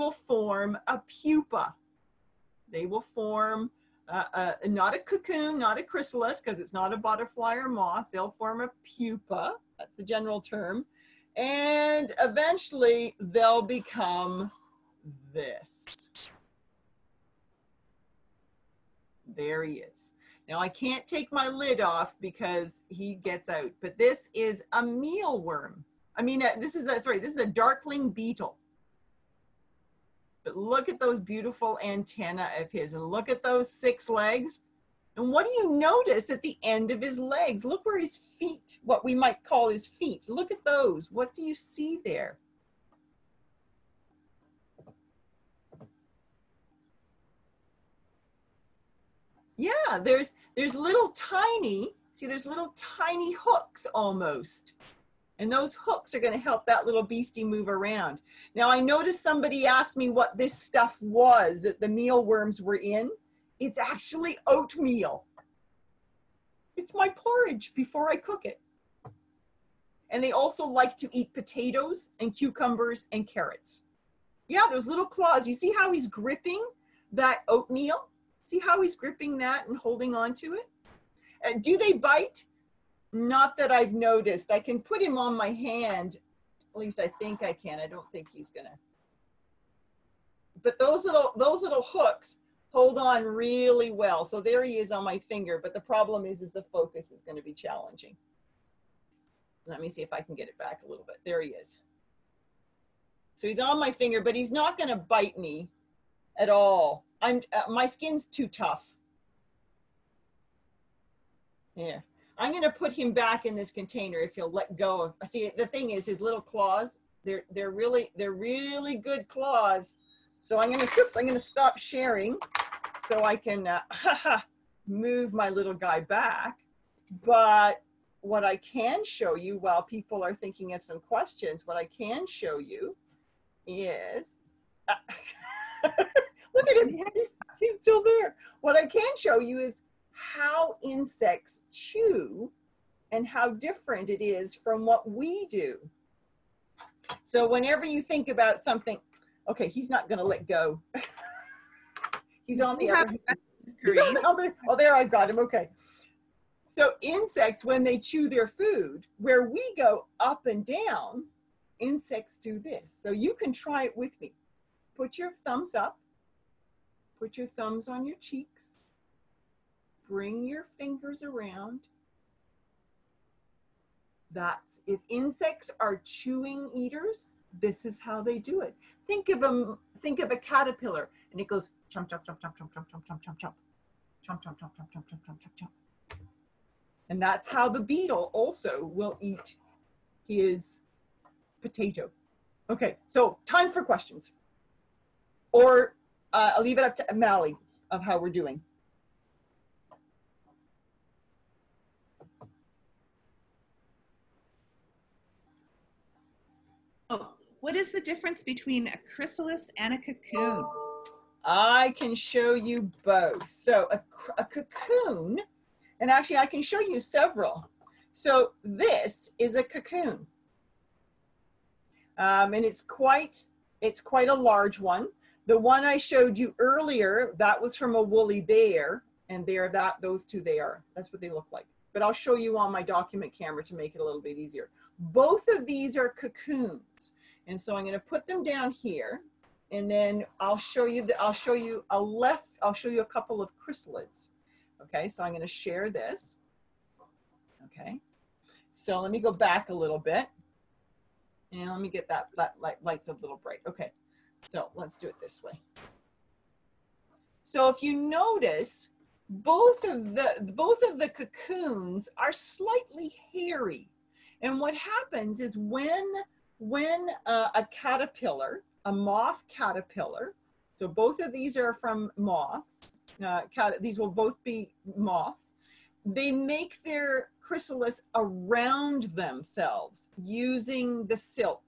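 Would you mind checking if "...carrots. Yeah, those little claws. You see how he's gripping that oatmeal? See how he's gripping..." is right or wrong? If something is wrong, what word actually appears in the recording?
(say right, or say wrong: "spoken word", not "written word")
right.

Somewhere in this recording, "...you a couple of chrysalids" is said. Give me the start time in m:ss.
4:02.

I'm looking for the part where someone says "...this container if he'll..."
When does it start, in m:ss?
1:53.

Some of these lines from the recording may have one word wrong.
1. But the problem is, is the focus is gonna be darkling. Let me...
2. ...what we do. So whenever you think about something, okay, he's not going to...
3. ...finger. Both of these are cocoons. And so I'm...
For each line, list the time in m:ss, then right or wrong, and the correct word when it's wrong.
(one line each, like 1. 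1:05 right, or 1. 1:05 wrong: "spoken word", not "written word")
1. 1:35 wrong: "challenging", not "darkling"
2. 2:24 right
3. 3:54 wrong: "easier", not "finger".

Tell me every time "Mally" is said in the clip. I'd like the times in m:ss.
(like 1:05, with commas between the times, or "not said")
3:17.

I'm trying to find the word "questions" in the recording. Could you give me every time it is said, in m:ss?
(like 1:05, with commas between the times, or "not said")
2:11, 3:13.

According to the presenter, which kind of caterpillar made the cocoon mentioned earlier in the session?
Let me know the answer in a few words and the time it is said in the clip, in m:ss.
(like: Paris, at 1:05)
Woolly bear, at 3:48.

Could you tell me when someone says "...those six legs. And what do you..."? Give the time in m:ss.
0:33.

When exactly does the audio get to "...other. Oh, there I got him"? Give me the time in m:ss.
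2:34.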